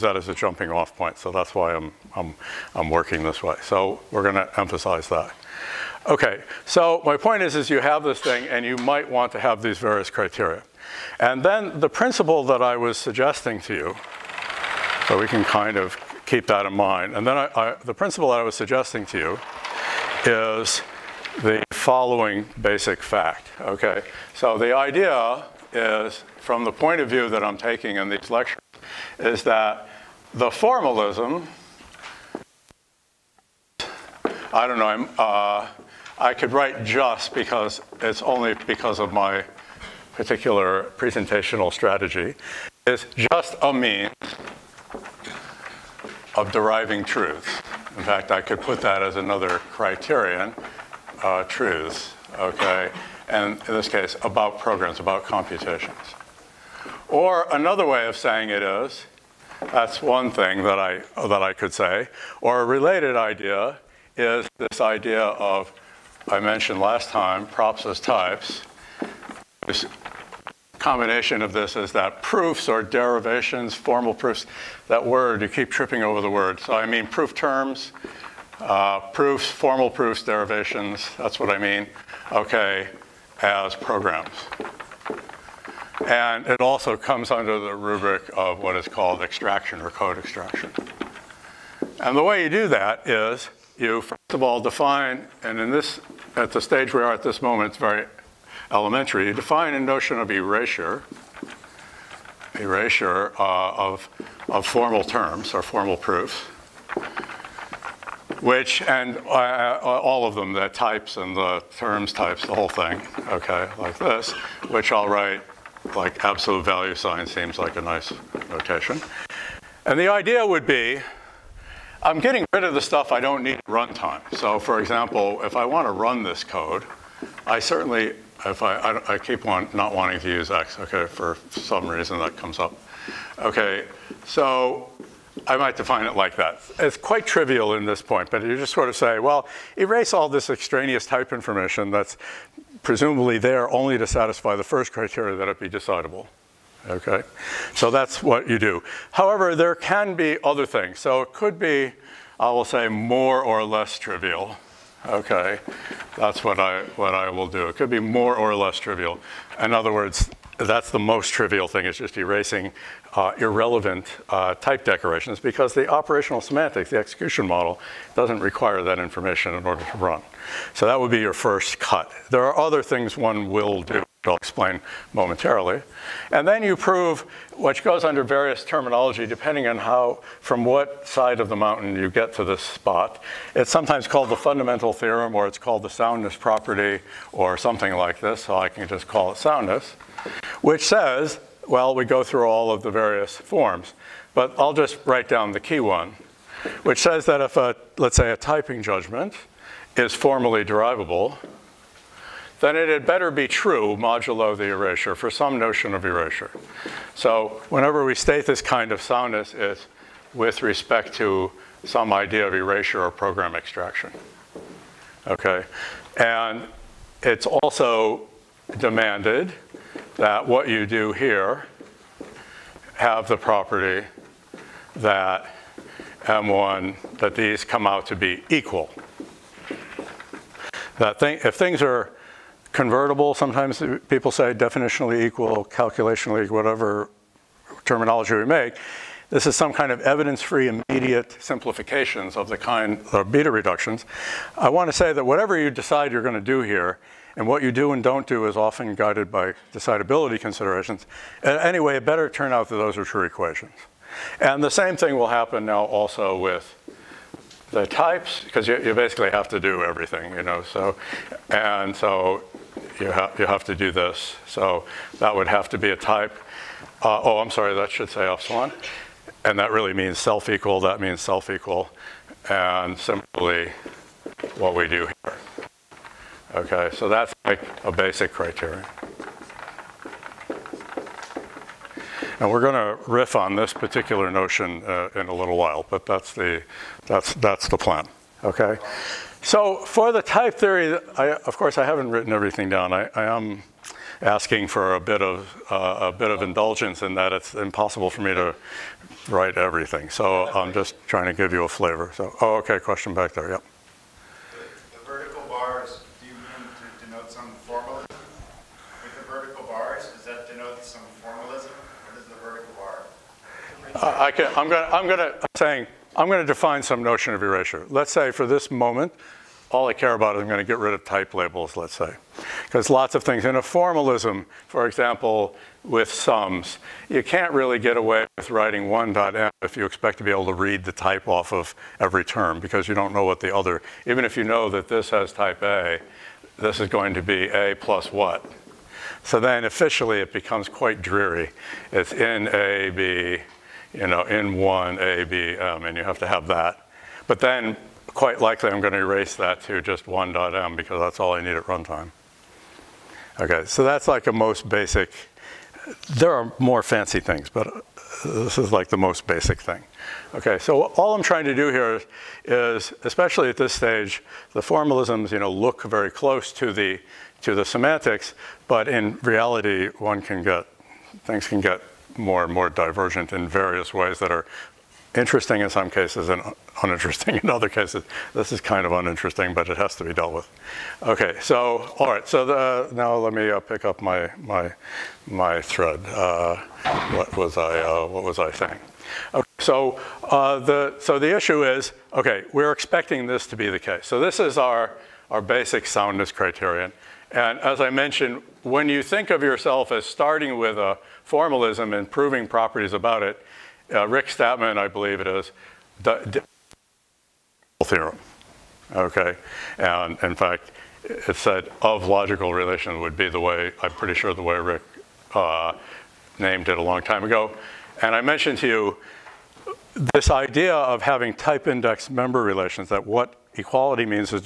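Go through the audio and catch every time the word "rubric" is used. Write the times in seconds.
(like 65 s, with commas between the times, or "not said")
87 s.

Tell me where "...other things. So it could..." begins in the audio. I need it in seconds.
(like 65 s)
150 s.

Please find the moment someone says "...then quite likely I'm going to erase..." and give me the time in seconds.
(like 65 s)
347 s.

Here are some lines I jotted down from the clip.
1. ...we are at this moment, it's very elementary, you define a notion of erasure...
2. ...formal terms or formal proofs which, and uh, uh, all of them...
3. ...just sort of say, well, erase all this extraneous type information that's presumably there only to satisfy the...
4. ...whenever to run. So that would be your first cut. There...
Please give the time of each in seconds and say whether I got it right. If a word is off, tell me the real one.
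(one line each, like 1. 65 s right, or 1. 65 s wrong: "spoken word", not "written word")
1. 96 s right
2. 104 s right
3. 138 s right
4. 169 s wrong: "order", not "whenever".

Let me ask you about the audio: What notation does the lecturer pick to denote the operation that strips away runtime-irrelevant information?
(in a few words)
absolute value sign.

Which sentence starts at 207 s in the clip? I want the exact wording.
So whenever we state this kind of soundness, it's with respect to some idea of erasure or program extraction.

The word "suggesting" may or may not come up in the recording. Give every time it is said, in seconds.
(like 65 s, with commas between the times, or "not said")
12 s, 18 s.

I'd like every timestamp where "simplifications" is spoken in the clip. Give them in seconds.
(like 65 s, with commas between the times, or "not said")
241 s.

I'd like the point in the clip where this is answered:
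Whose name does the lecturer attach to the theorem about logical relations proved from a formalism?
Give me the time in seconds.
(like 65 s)
404 s.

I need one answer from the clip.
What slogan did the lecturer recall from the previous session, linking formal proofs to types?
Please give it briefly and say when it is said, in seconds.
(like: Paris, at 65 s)
props as types, at 67 s.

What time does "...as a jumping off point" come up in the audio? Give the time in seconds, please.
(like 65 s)
0 s.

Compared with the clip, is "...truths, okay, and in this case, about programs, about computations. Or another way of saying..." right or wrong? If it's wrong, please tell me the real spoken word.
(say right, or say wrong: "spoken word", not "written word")
right.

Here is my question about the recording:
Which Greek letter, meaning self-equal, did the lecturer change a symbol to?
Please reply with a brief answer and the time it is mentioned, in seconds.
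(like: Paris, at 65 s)
epsilon, at 268 s.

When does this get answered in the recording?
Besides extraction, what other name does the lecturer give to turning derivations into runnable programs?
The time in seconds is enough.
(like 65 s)
89 s.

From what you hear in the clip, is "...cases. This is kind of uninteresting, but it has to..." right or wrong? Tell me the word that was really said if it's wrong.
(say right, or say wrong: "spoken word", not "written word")
right.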